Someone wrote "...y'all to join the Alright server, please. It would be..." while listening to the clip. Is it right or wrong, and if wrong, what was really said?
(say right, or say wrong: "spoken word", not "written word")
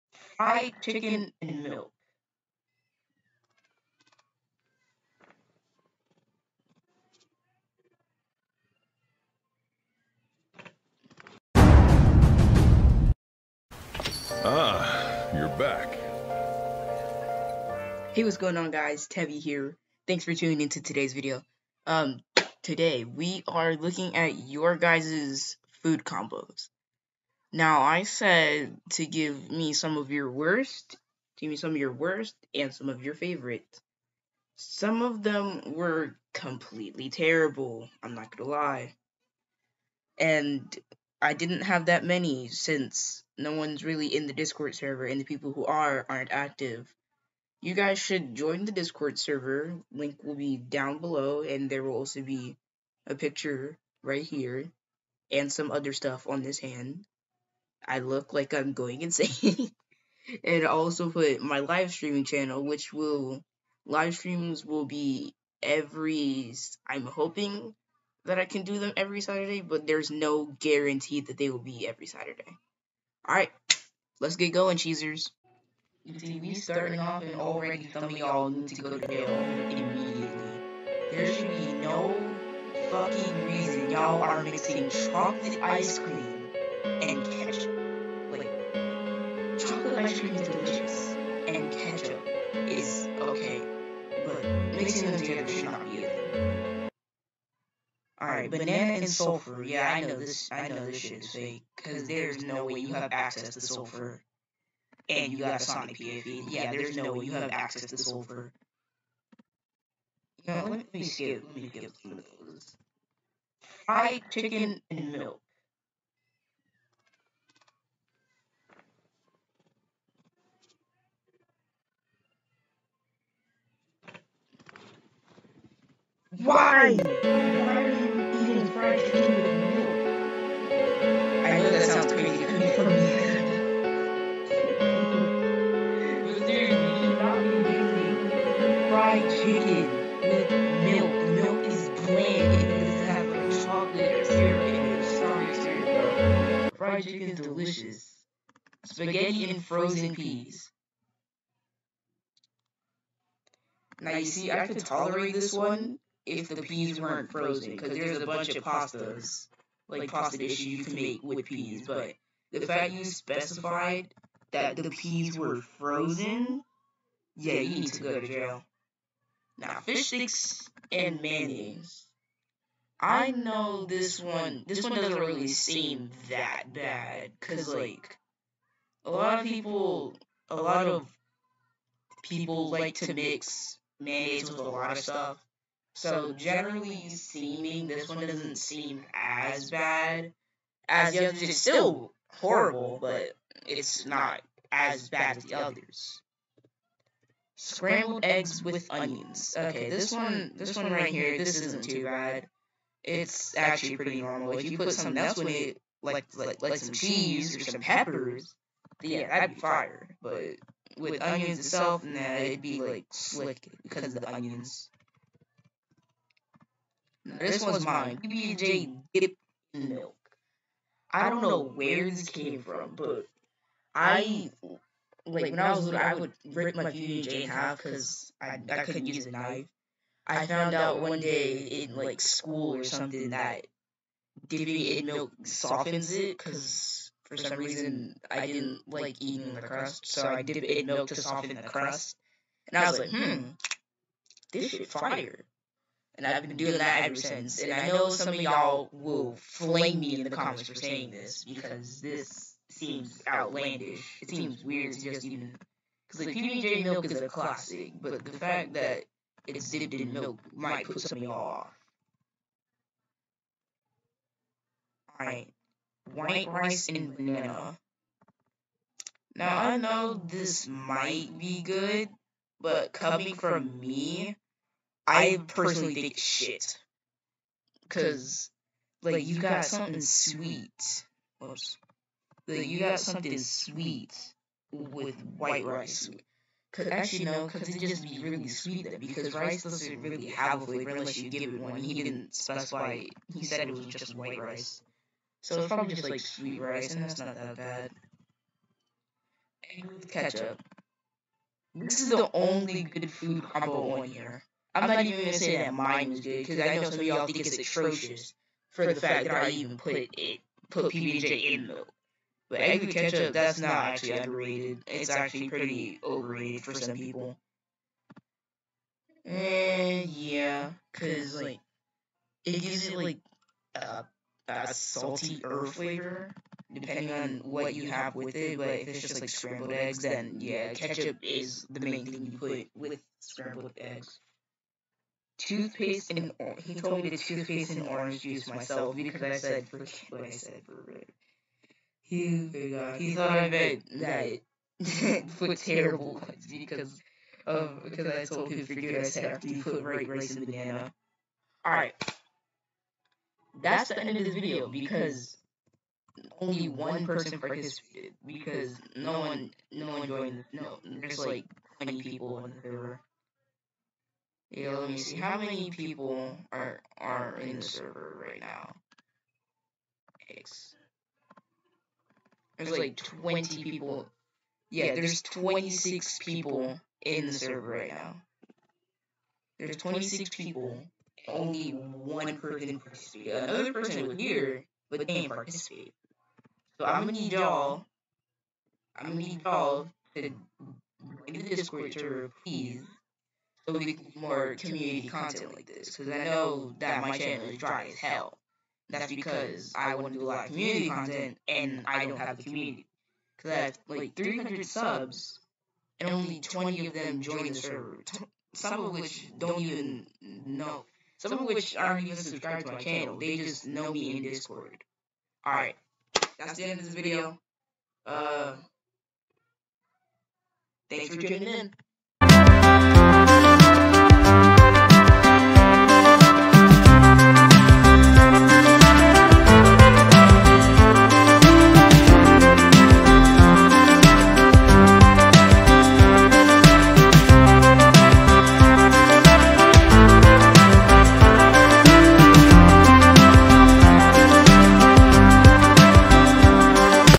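wrong: "Discord", not "Alright".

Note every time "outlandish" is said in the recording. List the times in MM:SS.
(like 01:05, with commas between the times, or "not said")
04:13.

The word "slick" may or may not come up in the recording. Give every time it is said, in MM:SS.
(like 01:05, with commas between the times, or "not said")
03:33.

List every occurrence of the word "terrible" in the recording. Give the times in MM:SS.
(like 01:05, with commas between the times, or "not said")
00:37, 05:45.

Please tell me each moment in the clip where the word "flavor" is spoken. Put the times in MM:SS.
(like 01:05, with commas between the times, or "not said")
04:50, 05:25.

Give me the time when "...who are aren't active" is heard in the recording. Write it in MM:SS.
00:45.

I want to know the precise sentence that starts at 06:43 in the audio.
Because I have like 300 subs and only 20 of them join the server.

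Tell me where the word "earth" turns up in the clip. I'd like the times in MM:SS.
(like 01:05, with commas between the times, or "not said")
05:25.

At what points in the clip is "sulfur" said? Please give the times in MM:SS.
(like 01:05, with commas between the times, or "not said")
01:39, 01:43, 01:47.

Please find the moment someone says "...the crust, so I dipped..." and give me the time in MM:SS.
03:59.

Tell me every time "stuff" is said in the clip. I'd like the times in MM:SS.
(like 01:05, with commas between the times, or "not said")
00:55, 03:04.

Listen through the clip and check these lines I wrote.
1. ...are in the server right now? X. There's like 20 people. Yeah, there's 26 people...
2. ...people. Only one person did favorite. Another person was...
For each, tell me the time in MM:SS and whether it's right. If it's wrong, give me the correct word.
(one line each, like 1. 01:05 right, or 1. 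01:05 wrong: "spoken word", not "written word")
1. 06:06 right
2. 06:20 wrong: "participate", not "favorite".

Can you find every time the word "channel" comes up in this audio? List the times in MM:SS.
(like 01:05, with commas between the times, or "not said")
01:02, 06:37, 06:52.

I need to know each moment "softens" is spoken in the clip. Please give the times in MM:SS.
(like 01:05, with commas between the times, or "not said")
03:55, 04:01.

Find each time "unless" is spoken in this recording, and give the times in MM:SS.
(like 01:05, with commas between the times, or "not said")
04:50.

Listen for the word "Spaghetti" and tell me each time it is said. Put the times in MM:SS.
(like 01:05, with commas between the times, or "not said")
02:28.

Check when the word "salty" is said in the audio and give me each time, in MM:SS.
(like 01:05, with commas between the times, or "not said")
05:24.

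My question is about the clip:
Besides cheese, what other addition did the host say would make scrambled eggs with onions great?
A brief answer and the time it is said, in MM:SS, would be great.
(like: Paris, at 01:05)
Peppers, at 03:27.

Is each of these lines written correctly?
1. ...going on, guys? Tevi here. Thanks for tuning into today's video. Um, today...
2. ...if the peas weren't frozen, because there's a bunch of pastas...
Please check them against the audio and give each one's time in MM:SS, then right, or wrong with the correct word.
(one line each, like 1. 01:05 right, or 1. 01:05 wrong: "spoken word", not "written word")
1. 00:18 right
2. 02:36 right.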